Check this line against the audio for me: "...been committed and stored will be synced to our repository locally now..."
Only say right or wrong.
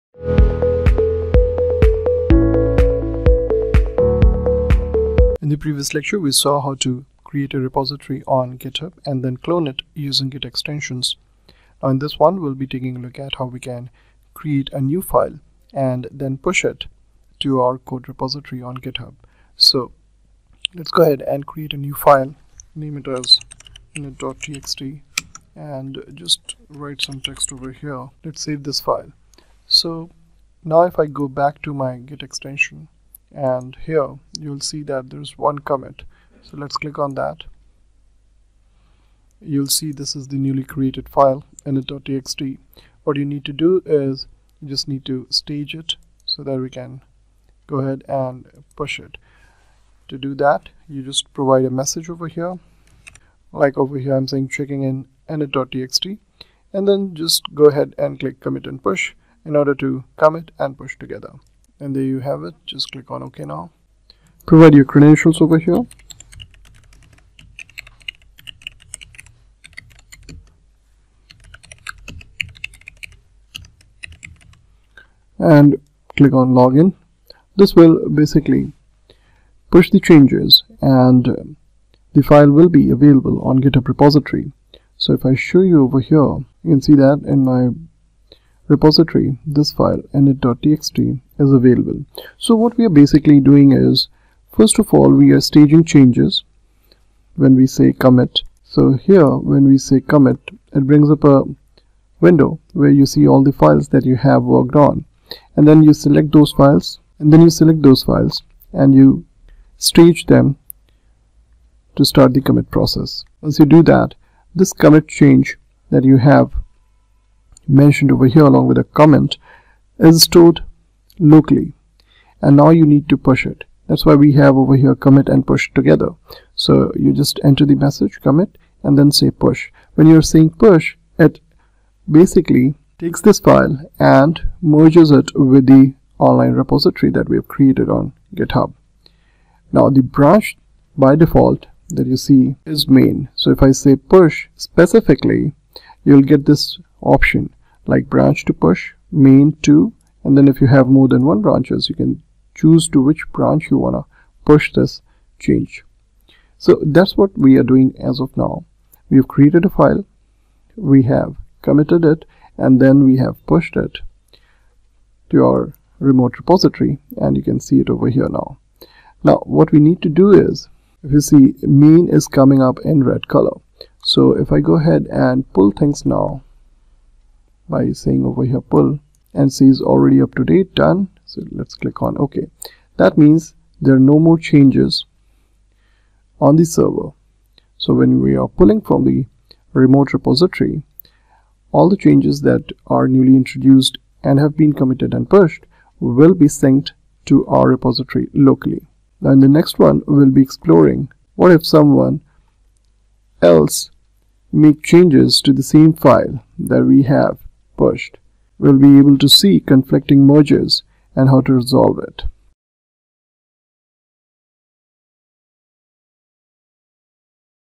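wrong.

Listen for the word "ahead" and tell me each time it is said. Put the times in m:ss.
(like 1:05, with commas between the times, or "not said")
0:21, 0:47, 0:57, 2:54.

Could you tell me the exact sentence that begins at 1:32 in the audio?
So what we are basically doing is, first of all, we are staging changes when we say commit.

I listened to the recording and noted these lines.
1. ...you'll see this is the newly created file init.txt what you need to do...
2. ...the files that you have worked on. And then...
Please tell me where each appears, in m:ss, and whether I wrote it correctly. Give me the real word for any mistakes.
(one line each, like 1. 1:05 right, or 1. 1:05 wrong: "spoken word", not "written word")
1. 0:39 right
2. 1:43 right.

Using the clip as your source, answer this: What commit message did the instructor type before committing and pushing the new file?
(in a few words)
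checking in init.txt.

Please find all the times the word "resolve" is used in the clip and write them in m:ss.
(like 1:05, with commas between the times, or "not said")
3:31.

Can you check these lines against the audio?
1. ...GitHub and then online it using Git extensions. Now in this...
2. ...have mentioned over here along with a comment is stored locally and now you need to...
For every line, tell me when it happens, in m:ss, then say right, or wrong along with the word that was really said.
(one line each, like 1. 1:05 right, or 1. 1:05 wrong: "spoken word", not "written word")
1. 0:08 wrong: "clone", not "online"
2. 1:56 right.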